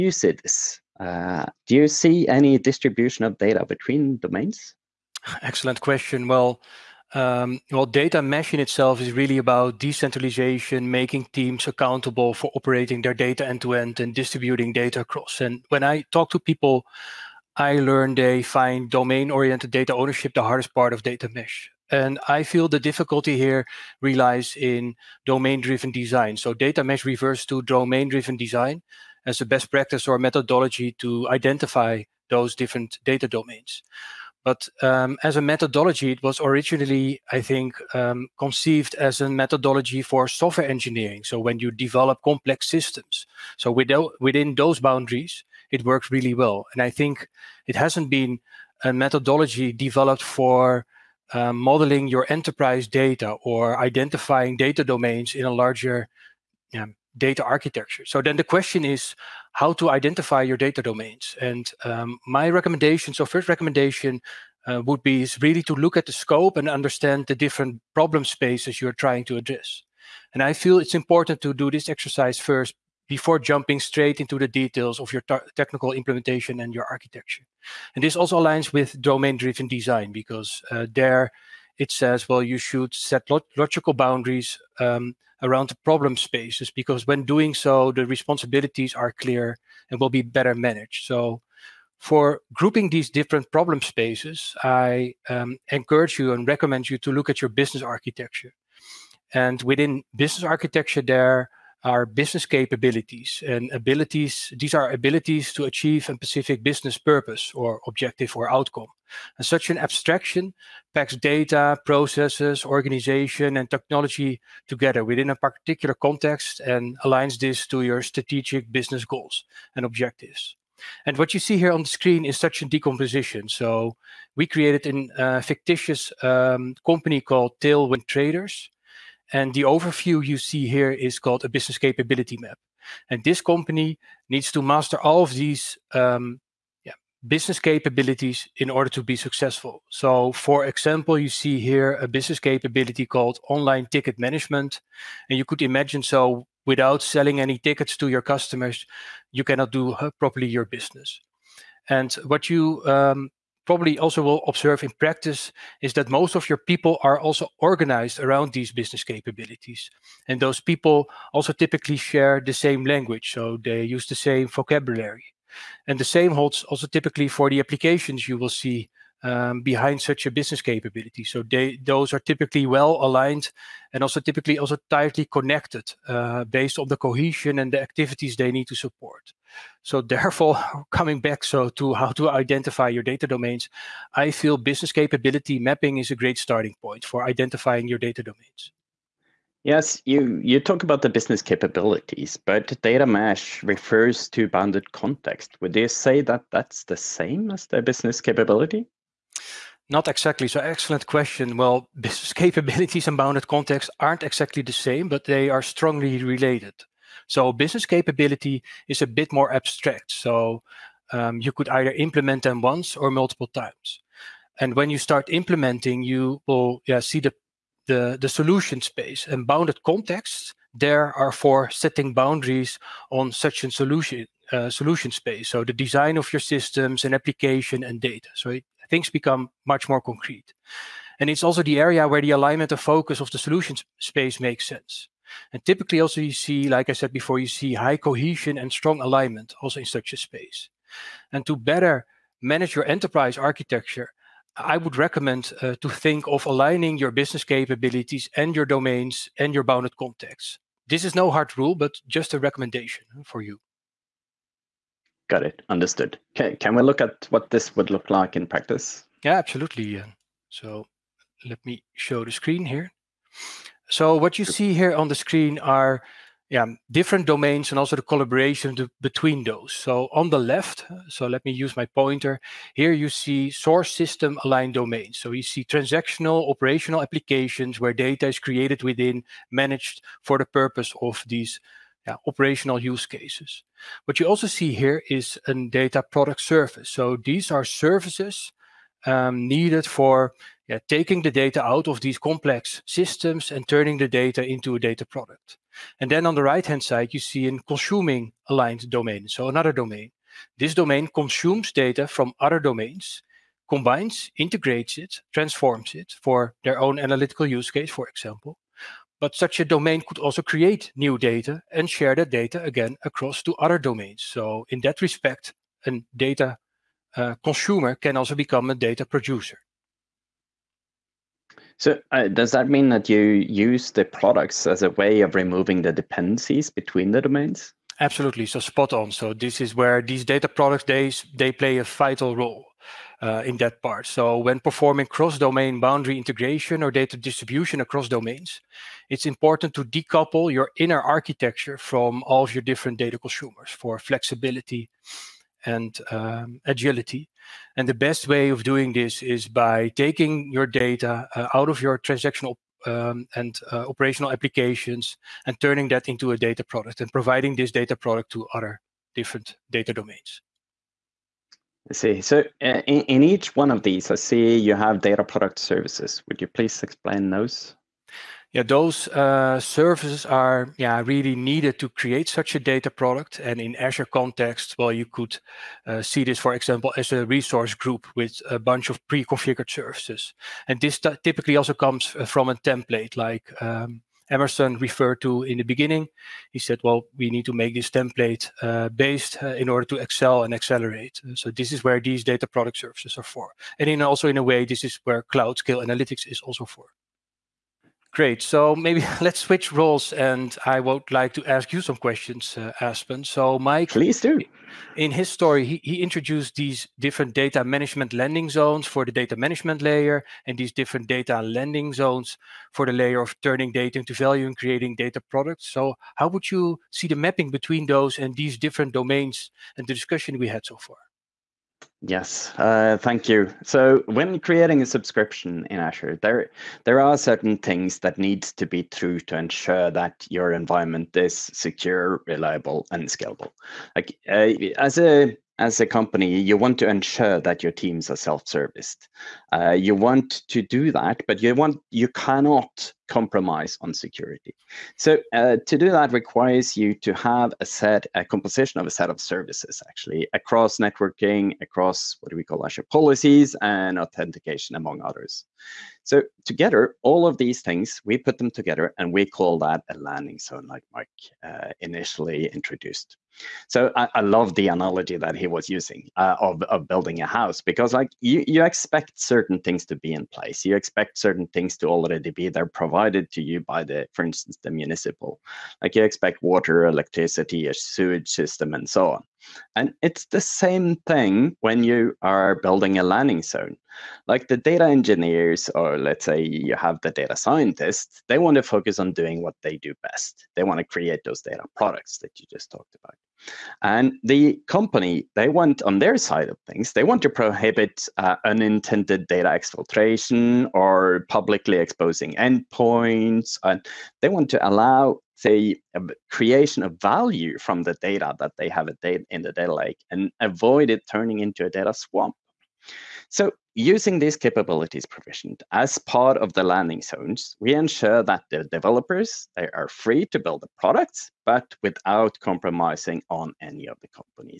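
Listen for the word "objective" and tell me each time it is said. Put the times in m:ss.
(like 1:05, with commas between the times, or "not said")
1:47, 1:59.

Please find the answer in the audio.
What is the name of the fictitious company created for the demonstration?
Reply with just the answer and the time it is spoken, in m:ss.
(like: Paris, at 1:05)
Tailwind Traders, at 2:07.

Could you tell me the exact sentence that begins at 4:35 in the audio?
So you see transactional operational applications where data is created within, managed for the purpose of these yeah, operational use cases.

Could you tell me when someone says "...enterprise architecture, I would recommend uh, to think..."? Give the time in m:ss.
4:02.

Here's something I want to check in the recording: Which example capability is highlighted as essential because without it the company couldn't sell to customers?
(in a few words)
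Online ticket management.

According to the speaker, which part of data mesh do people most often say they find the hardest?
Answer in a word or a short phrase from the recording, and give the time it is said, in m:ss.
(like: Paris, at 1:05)
Domain oriented data ownership, at 0:18.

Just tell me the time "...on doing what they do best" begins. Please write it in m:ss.
8:08.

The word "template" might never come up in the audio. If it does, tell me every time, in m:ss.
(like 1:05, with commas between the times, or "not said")
6:22, 6:27.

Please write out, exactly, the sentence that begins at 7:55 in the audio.
Like you expect water, electricity, a sewage system, and so on.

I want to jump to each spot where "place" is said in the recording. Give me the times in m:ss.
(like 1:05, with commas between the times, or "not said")
7:50.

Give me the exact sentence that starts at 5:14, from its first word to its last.
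So in that respect, a data uh, consumer can also become a data producer.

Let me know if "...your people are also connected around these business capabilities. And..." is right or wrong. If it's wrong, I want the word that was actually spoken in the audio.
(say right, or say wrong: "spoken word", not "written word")
wrong: "organized", not "connected".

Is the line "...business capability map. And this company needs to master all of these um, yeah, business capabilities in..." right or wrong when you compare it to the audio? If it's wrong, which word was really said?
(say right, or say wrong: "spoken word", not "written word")
right.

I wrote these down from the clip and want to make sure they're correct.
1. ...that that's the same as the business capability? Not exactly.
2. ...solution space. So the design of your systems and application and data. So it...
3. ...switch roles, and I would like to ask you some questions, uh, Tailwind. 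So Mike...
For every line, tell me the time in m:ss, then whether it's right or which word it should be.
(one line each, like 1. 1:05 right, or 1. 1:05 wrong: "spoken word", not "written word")
1. 3:16 right
2. 3:44 right
3. 6:39 wrong: "Aspen", not "Tailwind".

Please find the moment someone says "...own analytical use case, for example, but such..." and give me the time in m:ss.
5:06.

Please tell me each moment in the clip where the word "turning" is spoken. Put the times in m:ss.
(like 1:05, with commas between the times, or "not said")
4:53, 5:55, 6:53, 8:31.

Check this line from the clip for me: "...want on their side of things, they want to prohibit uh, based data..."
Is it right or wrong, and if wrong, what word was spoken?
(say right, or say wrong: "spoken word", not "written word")
wrong: "unintended", not "based".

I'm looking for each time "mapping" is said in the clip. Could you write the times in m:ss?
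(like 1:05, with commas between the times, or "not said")
3:05, 6:57.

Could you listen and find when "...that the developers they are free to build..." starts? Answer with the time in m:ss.
8:38.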